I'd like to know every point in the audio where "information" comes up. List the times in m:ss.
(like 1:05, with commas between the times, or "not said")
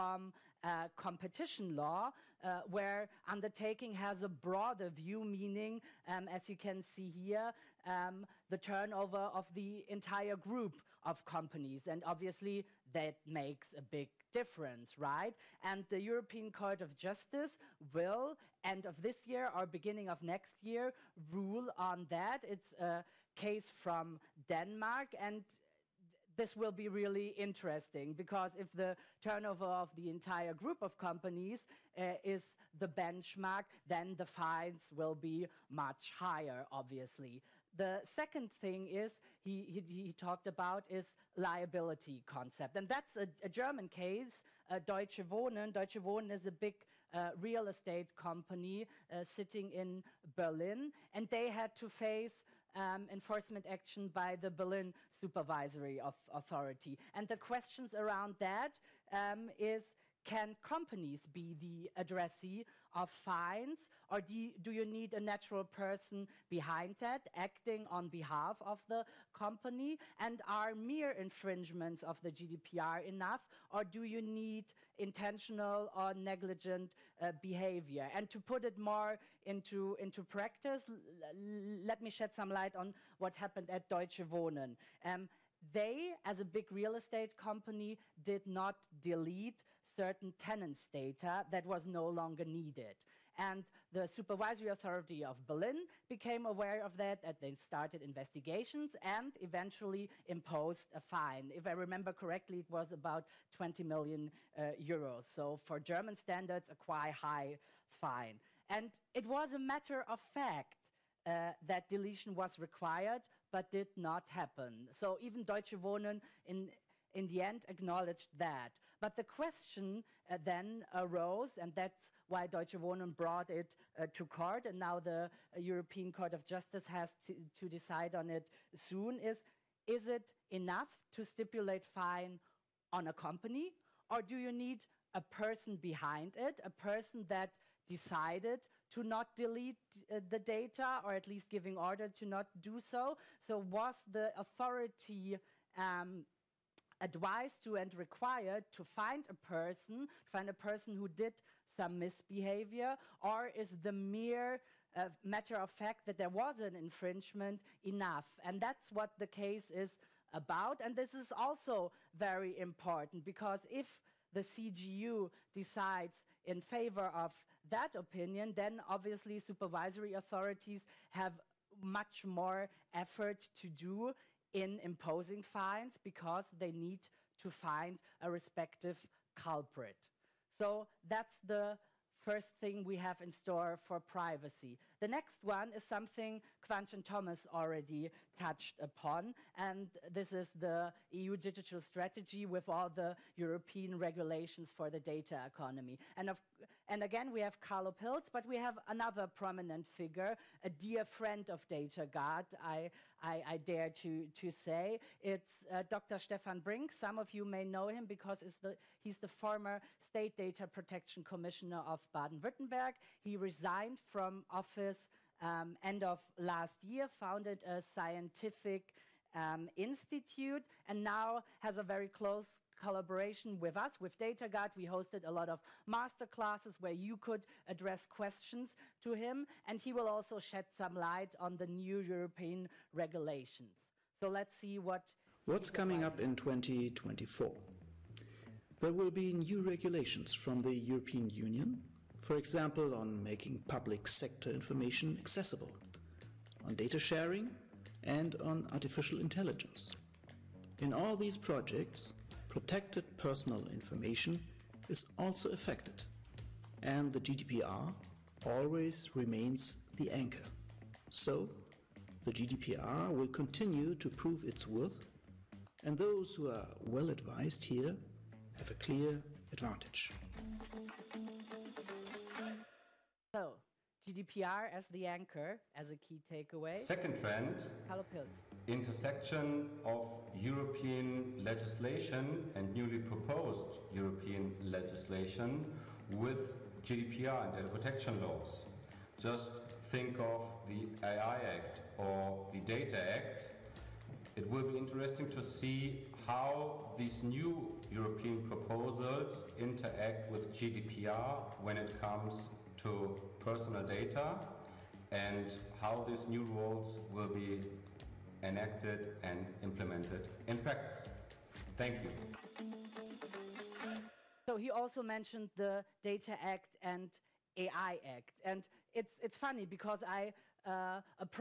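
4:04, 4:13.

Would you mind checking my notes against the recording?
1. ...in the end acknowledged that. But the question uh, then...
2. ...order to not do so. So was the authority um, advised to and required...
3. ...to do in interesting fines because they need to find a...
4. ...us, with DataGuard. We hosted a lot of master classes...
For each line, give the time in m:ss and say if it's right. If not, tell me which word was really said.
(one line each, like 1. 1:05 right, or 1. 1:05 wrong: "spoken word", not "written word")
1. 1:57 right
2. 2:21 right
3. 2:53 wrong: "imposing", not "interesting"
4. 3:43 right.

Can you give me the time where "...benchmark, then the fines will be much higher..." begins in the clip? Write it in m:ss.
0:33.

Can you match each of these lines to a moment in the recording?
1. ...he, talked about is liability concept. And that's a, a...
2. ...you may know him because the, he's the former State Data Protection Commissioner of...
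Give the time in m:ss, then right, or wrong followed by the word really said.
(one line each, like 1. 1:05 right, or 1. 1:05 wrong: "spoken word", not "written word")
1. 0:39 right
2. 3:27 right.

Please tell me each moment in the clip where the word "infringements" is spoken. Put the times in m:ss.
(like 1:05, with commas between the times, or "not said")
1:11, 2:36.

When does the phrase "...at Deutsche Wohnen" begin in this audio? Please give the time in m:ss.
1:23.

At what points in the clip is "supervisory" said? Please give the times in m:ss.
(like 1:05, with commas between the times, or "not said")
0:55, 1:34, 2:49.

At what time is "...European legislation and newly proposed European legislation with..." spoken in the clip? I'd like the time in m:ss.
4:40.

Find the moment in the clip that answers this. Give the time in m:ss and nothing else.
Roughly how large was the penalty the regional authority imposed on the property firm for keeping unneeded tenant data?
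1:43.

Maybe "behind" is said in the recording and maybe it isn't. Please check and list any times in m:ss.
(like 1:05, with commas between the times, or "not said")
1:06, 2:15.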